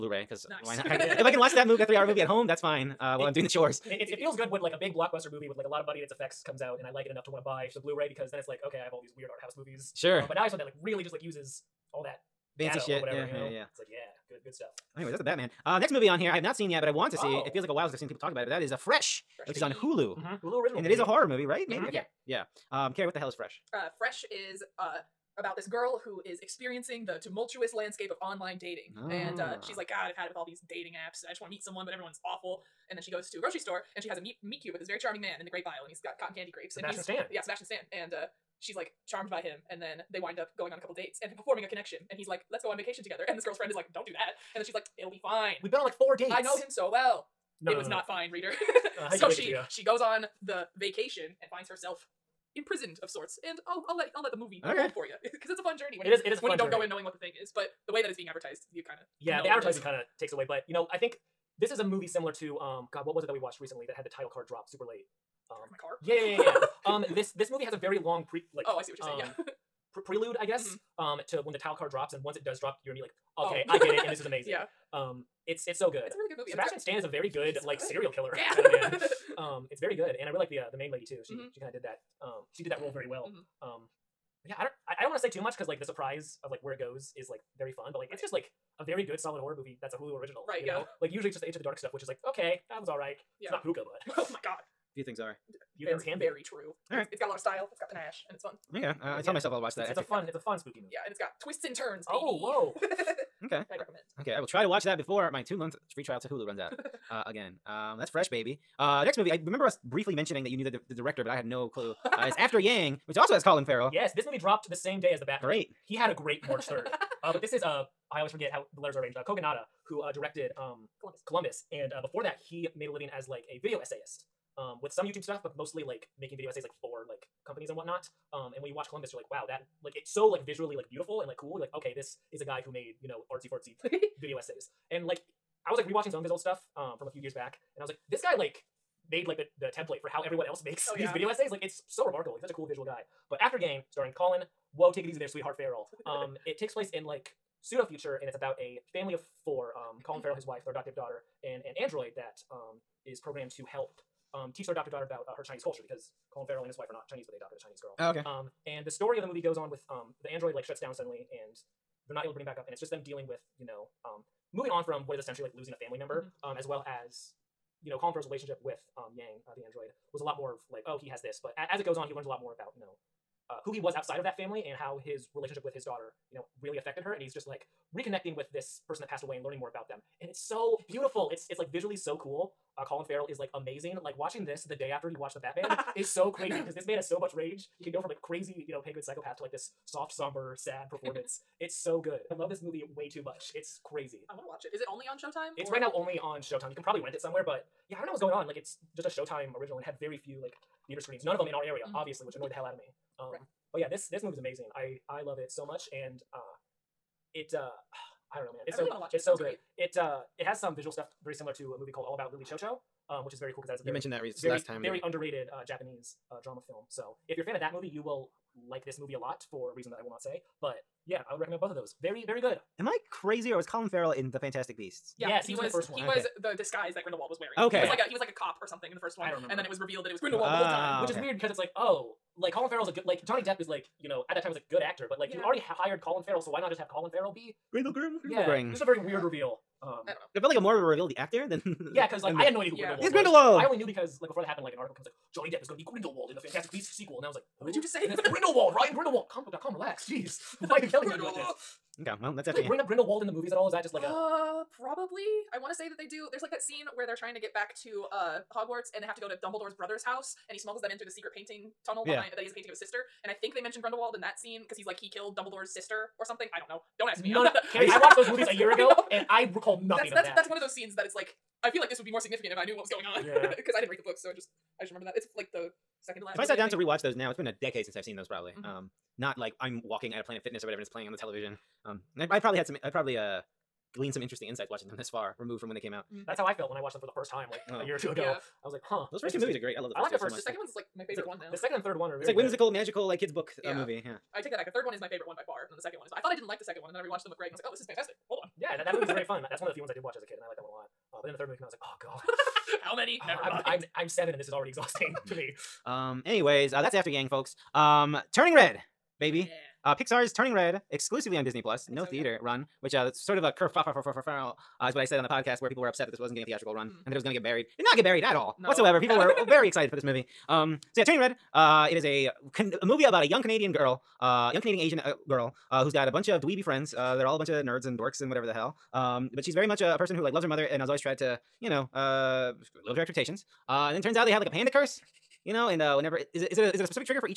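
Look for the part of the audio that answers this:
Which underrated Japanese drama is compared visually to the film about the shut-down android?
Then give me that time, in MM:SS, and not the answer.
03:32.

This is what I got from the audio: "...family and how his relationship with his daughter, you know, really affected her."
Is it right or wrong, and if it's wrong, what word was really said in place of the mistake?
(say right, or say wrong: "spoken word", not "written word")
right.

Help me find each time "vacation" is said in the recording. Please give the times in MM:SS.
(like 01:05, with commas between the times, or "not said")
00:42, 00:50.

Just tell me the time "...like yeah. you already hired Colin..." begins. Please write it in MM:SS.
03:55.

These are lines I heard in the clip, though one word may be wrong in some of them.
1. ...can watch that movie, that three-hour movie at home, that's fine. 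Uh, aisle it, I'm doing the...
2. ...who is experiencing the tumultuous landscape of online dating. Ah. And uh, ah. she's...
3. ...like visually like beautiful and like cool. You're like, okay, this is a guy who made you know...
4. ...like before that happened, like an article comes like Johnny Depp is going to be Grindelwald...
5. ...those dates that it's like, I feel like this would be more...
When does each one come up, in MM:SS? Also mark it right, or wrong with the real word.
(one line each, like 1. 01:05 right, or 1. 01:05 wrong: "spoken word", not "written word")
1. 00:01 wrong: "while", not "aisle"
2. 00:26 right
3. 02:10 right
4. 04:04 right
5. 04:30 wrong: "scenes", not "dates".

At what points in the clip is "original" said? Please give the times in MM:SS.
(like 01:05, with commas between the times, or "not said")
00:20, 01:30, 03:19.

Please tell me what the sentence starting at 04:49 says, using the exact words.
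Those first two movies are great.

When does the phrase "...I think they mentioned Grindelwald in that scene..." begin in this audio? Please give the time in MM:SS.
04:23.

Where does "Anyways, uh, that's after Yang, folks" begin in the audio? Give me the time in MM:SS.
05:06.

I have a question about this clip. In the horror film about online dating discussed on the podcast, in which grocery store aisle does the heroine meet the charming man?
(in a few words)
grape aisle.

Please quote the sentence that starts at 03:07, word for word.
He can go from like crazy, you know, good psychopath to like this soft, somber, sad performance.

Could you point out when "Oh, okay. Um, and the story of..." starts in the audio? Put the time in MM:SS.
02:37.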